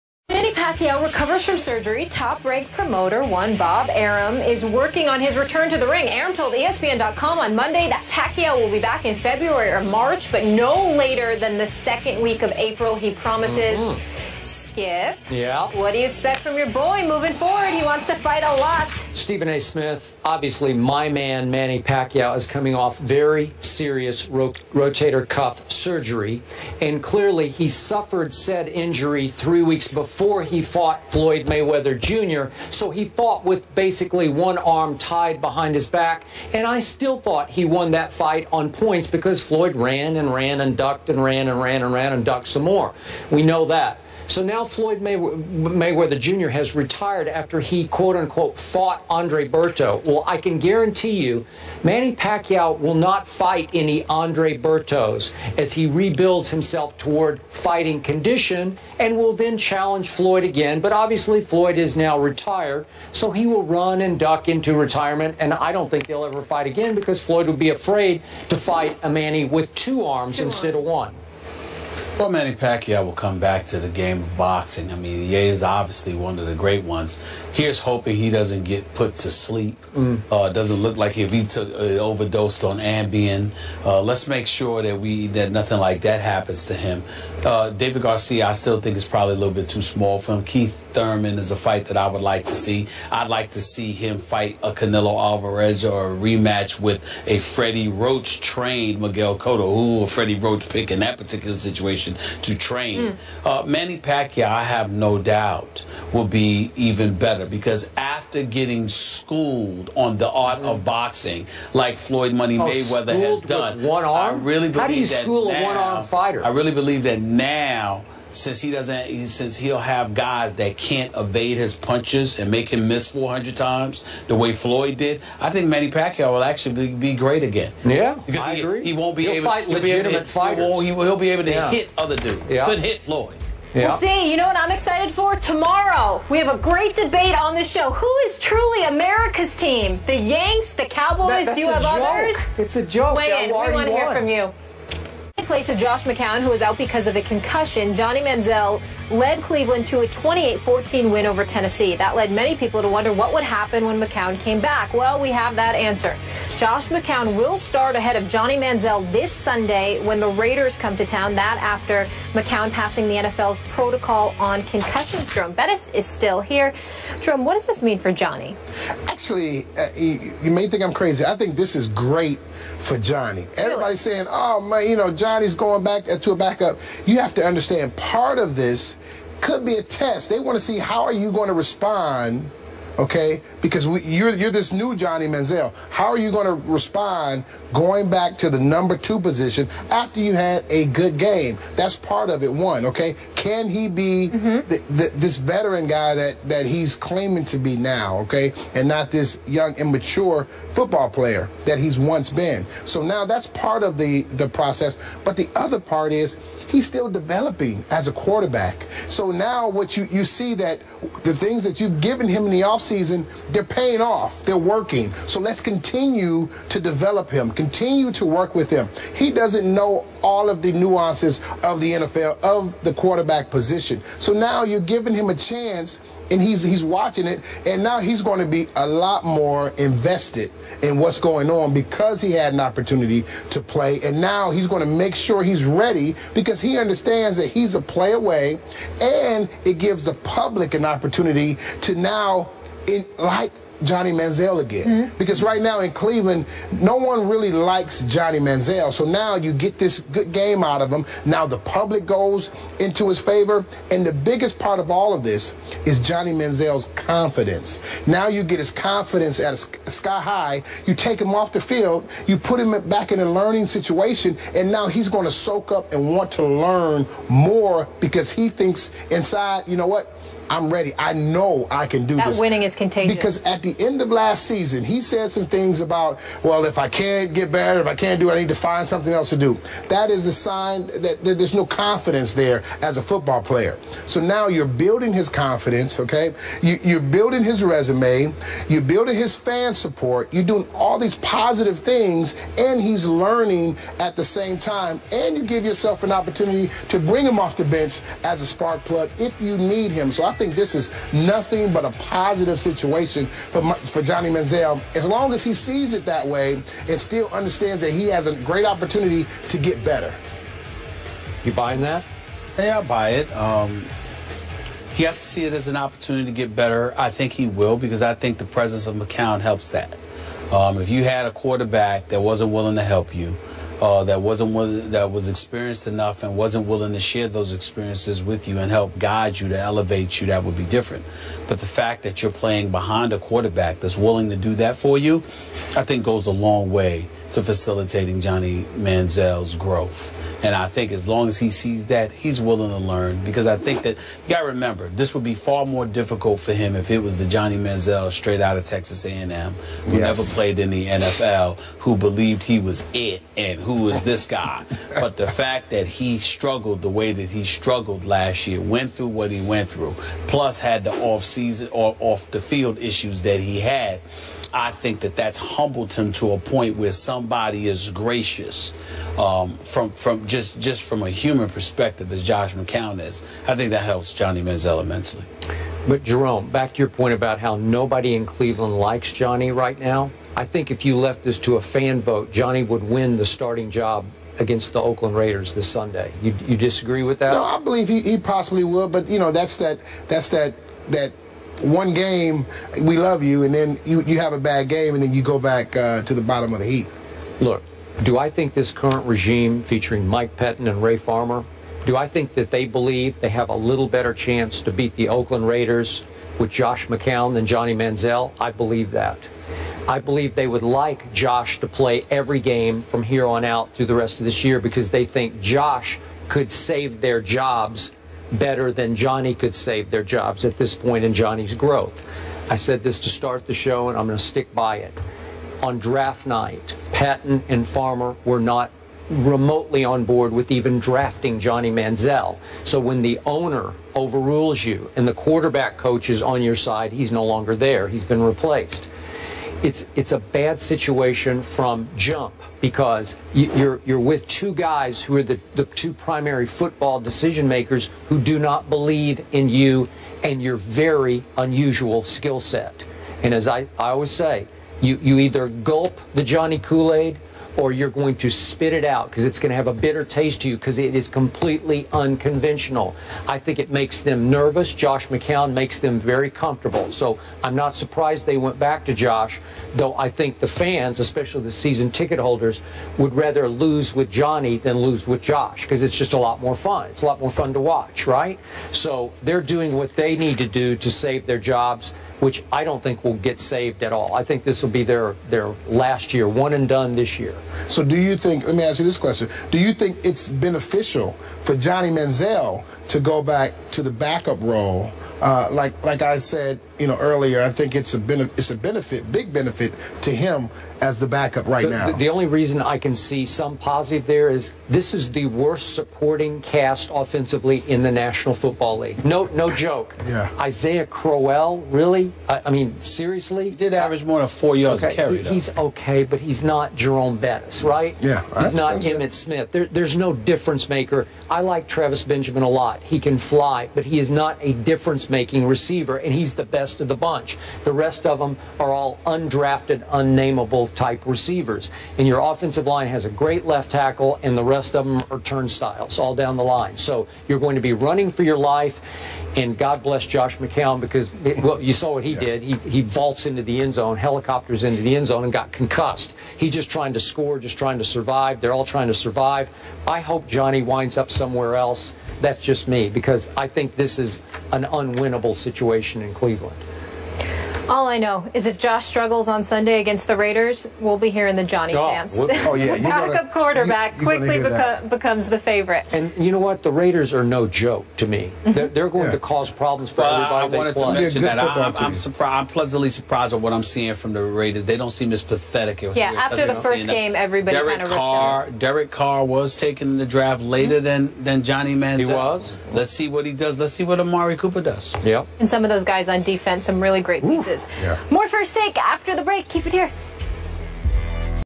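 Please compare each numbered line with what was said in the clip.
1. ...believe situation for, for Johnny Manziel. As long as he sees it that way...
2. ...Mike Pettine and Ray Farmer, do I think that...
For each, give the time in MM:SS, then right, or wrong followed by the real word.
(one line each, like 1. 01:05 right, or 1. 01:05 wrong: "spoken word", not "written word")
1. 05:01 wrong: "positive", not "believe"
2. 06:40 right.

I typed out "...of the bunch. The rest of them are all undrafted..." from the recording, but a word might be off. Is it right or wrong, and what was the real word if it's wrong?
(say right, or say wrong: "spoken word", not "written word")
right.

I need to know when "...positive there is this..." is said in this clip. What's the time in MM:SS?
08:23.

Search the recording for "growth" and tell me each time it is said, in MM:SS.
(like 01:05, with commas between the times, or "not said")
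05:39, 07:01.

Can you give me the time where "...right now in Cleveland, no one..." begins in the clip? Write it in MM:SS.
04:05.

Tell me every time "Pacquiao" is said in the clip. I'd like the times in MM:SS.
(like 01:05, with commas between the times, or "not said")
00:00, 00:08, 00:21, 00:52, 01:12, 01:43, 02:05.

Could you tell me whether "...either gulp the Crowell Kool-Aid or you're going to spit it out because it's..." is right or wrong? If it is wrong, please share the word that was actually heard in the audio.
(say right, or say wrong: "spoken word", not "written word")
wrong: "Johnny", not "Crowell".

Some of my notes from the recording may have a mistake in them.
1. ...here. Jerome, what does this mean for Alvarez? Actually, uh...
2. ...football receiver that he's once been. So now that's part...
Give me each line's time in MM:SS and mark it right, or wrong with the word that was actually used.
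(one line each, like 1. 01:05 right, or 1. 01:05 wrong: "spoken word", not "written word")
1. 02:46 wrong: "Johnny", not "Alvarez"
2. 03:20 wrong: "player", not "receiver".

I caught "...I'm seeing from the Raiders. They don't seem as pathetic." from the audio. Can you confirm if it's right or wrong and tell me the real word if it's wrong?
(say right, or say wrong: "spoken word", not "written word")
right.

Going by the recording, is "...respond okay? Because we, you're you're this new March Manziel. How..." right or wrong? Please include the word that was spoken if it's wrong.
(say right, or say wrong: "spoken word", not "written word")
wrong: "Johnny", not "March".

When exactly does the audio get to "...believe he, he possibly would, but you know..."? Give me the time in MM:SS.
06:27.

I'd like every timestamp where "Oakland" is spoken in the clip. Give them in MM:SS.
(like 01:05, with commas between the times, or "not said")
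06:24, 06:45.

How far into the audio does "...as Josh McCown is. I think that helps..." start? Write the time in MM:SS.
06:12.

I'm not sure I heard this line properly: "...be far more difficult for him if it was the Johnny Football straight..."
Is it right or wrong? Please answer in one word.
wrong.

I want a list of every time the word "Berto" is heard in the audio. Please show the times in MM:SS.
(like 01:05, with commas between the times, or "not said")
00:49, 00:54.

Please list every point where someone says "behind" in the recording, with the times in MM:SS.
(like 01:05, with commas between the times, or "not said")
00:35, 05:32.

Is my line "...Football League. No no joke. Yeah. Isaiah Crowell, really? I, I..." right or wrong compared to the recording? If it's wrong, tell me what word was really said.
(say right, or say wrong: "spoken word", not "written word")
right.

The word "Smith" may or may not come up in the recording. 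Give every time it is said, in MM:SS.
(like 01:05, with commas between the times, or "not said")
00:19, 08:39.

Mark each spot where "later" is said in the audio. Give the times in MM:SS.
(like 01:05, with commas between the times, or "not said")
00:10, 09:40.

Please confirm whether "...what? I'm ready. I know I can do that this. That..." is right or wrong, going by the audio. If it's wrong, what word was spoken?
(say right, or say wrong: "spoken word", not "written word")
right.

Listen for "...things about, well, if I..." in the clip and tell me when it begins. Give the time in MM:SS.
04:35.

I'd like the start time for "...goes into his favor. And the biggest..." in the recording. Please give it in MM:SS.
04:12.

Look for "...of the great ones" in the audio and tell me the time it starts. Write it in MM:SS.
01:16.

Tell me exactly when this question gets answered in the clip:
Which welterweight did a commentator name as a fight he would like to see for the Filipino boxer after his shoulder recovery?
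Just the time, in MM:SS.
01:30.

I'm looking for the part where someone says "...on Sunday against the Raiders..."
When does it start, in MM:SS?
09:19.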